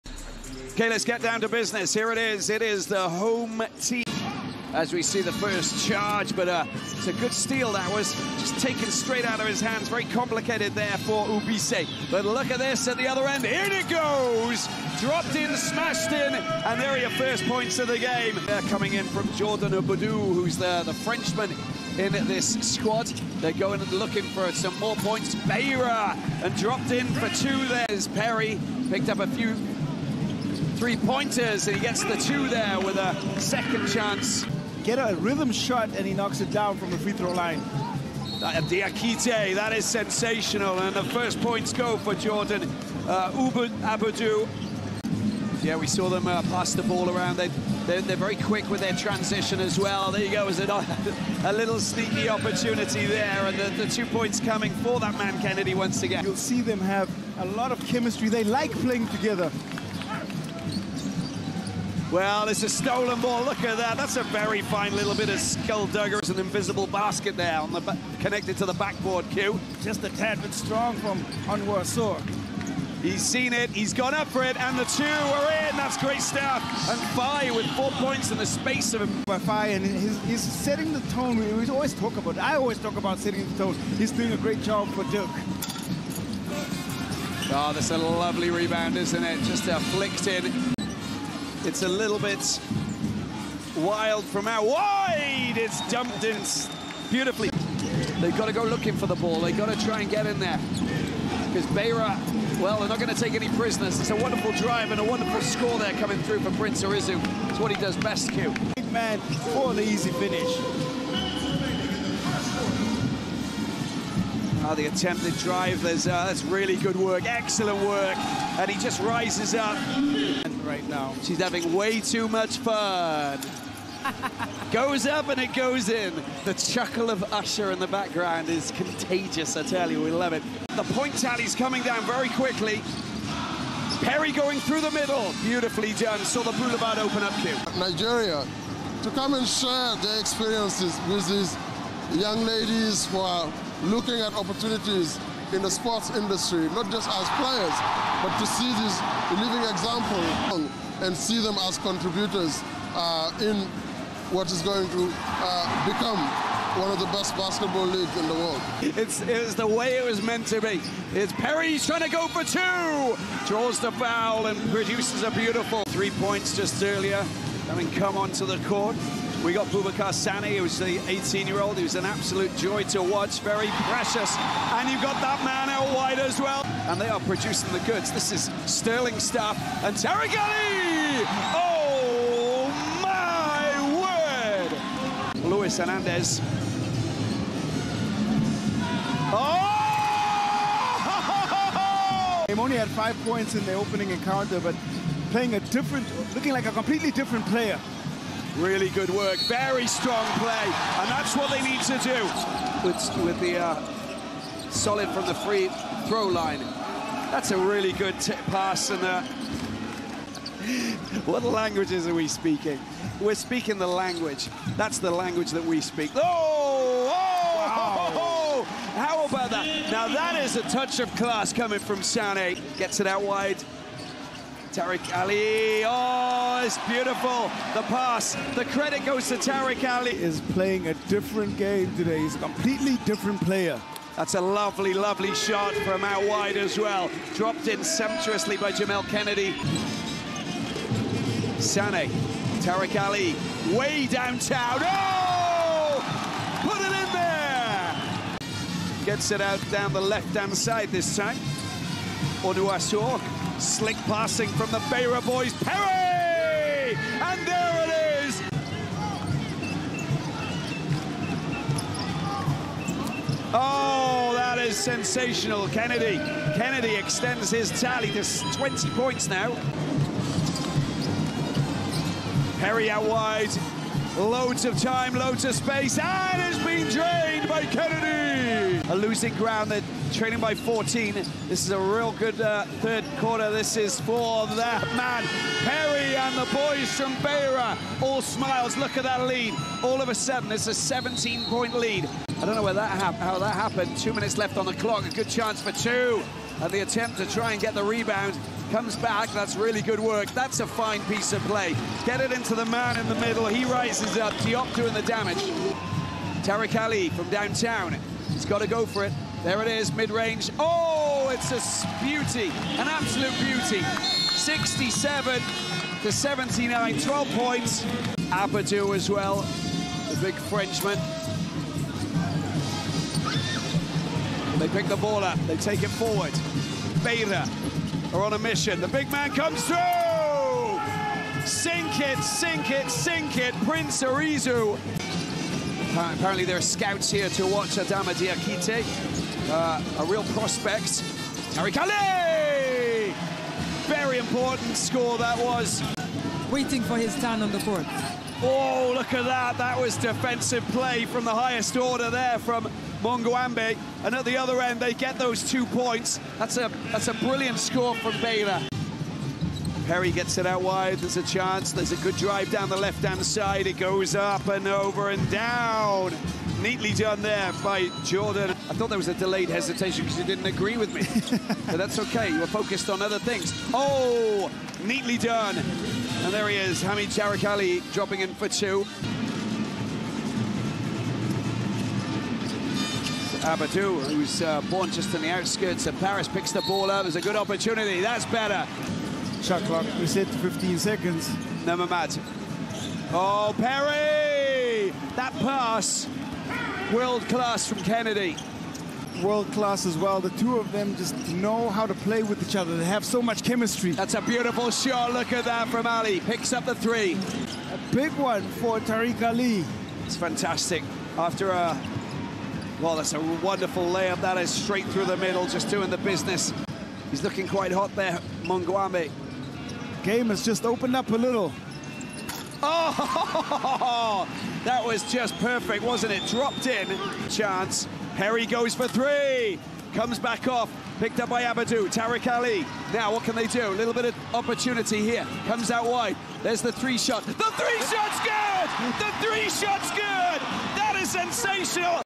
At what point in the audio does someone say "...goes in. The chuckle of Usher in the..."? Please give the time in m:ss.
2:05.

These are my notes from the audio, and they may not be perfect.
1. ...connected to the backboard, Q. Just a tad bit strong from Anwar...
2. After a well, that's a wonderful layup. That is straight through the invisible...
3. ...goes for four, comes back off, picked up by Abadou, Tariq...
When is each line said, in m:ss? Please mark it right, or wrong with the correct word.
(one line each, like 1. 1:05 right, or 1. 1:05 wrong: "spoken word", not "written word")
1. 1:08 right
2. 6:51 wrong: "middle", not "invisible"
3. 7:08 wrong: "three", not "four".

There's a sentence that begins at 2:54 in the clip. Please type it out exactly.
And you've got that man out wide as well.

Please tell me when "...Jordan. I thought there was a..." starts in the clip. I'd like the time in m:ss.
6:08.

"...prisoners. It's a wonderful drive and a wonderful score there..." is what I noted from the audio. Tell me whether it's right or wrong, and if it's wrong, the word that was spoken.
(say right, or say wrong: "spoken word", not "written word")
right.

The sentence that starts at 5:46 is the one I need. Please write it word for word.
Waiting for his turn on the court.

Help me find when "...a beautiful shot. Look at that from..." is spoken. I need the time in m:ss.
6:44.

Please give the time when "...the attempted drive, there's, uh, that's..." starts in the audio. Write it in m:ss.
1:54.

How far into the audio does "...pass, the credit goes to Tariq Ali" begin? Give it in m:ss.
3:47.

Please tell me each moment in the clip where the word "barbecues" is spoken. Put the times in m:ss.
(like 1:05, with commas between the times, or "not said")
not said.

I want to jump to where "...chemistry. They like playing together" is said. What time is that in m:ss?
0:57.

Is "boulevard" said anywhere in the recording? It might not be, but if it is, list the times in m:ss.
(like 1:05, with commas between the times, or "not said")
2:16.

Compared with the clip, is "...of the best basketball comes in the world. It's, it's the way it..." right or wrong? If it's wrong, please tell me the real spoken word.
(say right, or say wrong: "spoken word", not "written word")
wrong: "leagues", not "comes".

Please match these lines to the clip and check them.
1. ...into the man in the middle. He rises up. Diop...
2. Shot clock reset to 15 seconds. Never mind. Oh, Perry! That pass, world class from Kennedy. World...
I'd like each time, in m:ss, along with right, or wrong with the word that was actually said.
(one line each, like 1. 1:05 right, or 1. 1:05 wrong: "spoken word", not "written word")
1. 5:02 right
2. 6:29 right.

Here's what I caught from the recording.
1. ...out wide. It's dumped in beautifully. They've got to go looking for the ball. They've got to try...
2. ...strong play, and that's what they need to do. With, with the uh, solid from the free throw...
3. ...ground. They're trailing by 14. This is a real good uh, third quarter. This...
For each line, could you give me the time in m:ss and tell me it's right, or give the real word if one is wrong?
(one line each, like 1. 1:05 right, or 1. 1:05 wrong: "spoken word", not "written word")
1. 1:34 right
2. 3:19 right
3. 4:39 right.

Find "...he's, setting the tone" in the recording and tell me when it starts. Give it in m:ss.
1:20.